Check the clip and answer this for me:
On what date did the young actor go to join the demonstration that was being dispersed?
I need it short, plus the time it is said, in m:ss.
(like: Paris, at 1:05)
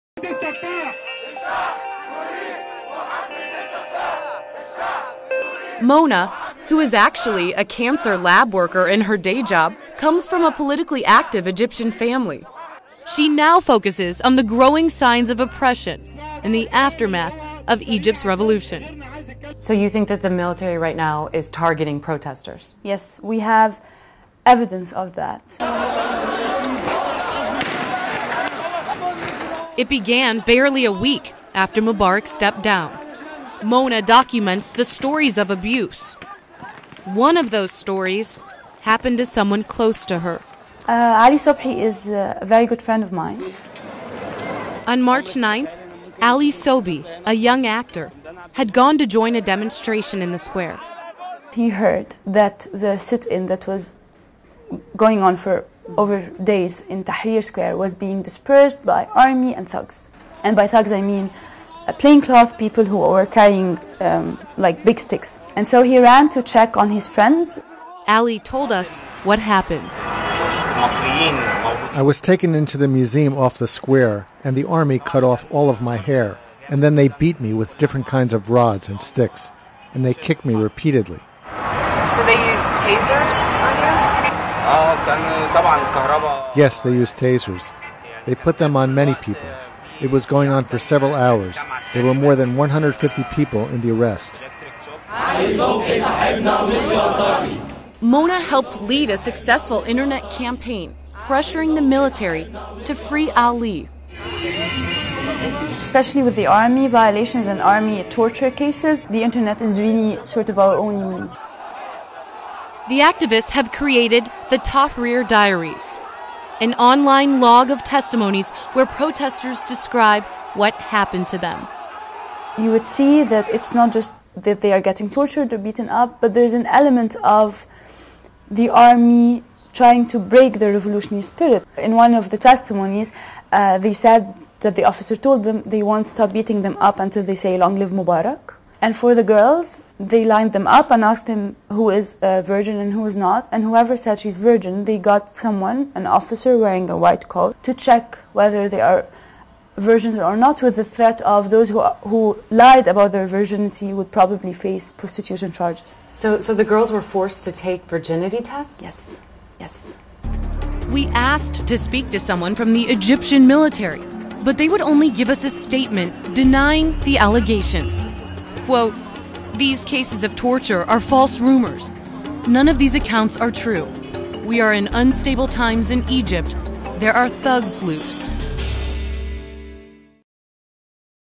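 March 9, at 0:45.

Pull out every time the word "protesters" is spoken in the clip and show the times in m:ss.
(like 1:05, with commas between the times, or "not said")
0:21, 1:58.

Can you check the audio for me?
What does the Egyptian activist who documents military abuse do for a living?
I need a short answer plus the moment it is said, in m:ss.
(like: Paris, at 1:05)
Cancer lab worker, at 0:07.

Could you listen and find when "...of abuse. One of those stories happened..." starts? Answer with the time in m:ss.
0:35.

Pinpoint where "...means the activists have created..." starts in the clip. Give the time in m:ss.
1:51.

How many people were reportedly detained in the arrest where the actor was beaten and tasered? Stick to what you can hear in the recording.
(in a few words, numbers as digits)
150.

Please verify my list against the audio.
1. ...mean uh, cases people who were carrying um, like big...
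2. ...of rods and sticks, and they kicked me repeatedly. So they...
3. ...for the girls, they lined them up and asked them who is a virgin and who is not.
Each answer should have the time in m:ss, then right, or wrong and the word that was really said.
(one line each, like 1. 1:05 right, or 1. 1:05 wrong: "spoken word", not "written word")
1. 1:01 wrong: "plainclothes", not "cases"
2. 1:18 right
3. 2:18 right.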